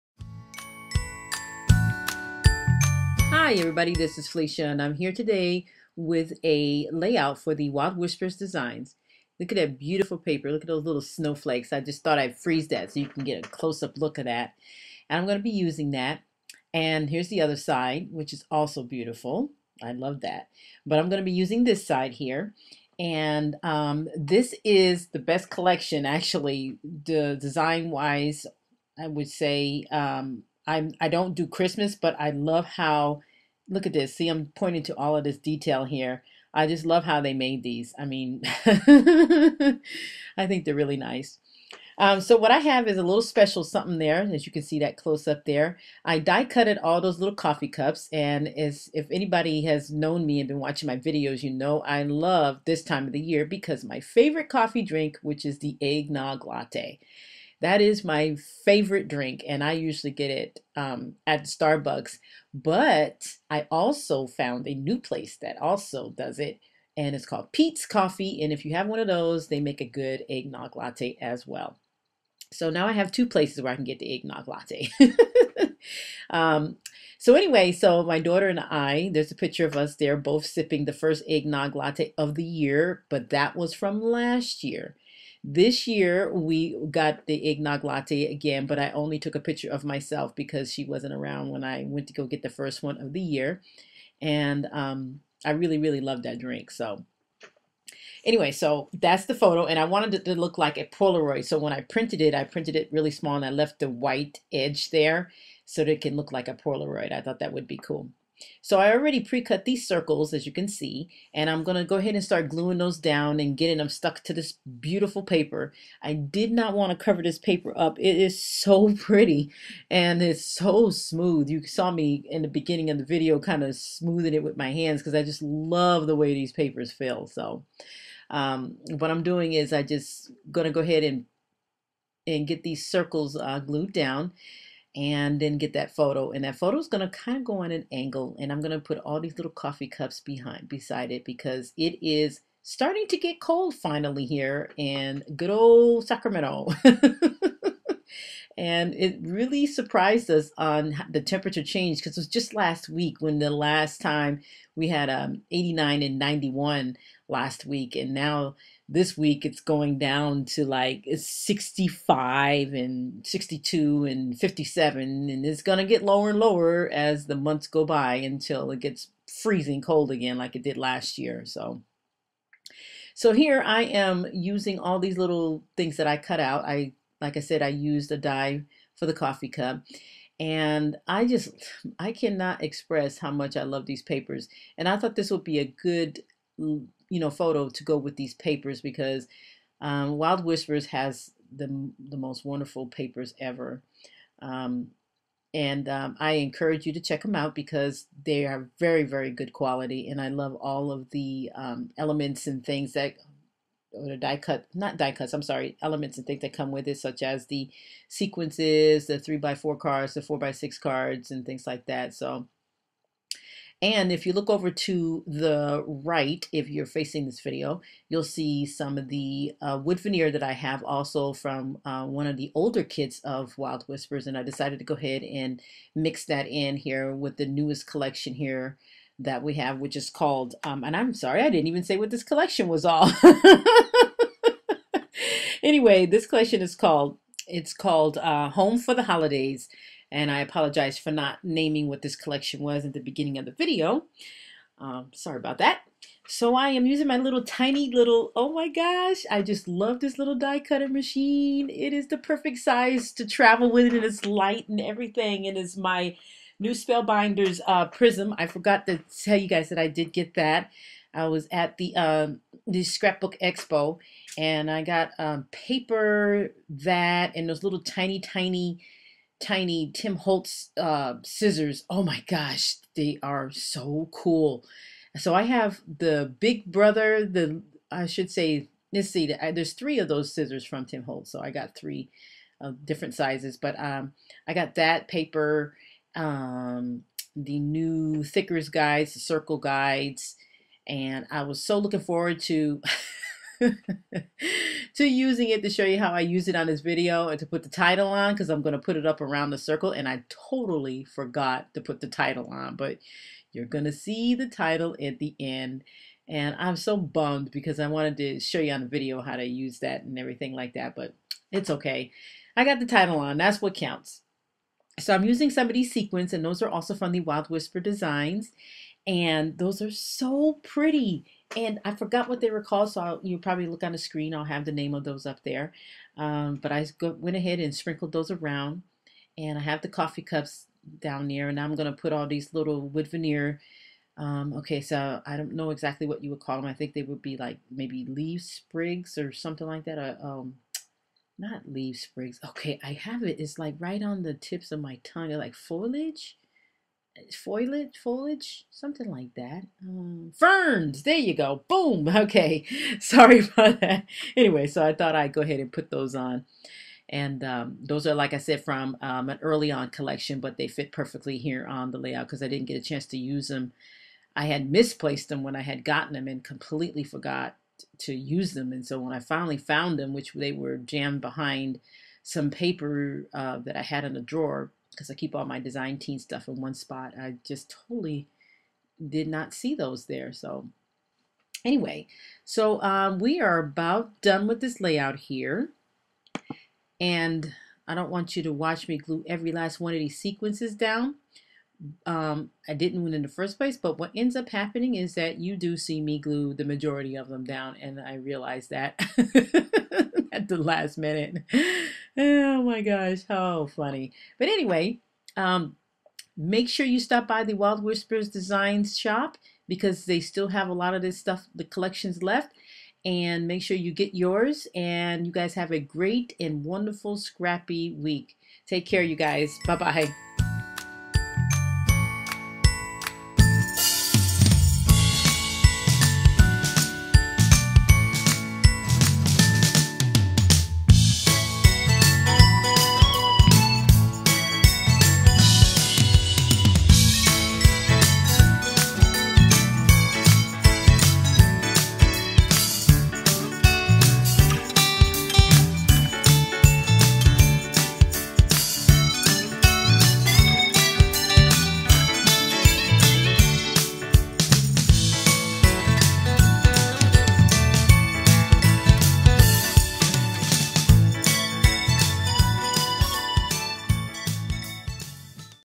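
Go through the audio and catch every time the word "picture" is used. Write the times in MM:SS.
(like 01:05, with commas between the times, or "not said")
01:19, 01:29.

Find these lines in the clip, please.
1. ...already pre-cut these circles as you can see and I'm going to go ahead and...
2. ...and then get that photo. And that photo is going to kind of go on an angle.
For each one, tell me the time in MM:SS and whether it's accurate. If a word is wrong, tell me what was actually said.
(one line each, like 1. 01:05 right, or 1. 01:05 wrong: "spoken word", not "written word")
1. 01:48 right
2. 02:14 right.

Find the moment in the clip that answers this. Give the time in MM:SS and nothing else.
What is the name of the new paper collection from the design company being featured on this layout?
03:58.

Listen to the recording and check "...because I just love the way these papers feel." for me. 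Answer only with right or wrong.
right.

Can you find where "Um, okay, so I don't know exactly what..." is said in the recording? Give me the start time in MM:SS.
05:34.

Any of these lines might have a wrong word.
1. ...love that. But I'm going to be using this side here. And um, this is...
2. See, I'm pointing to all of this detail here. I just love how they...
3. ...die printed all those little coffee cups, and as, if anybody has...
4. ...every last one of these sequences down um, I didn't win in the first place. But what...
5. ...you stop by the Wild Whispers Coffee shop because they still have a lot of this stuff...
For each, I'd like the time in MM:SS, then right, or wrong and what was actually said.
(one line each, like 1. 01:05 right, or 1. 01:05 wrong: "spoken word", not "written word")
1. 00:19 right
2. 00:34 right
3. 00:46 wrong: "cutted", not "printed"
4. 06:29 right
5. 06:46 wrong: "Designs", not "Coffee".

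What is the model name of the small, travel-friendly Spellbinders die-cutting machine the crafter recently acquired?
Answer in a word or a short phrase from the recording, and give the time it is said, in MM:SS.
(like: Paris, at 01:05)
Prism, at 04:17.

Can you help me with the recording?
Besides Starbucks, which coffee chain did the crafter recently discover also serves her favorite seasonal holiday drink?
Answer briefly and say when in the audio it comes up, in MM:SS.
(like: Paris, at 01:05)
Peet's Coffee, at 01:07.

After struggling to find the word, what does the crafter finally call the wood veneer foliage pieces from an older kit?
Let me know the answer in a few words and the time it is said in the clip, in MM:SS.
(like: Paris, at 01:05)
ferns, at 05:50.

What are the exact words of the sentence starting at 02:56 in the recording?
I like I said, I used a dye for the coffee cup.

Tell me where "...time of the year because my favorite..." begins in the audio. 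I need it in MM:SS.
00:52.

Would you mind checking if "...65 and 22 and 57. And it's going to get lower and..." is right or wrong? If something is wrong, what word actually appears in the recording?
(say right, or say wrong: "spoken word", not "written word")
wrong: "62", not "22".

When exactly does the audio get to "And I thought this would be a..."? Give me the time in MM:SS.
03:04.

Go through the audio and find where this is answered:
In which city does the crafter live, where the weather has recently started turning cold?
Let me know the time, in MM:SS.
02:26.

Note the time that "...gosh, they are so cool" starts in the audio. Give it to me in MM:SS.
04:32.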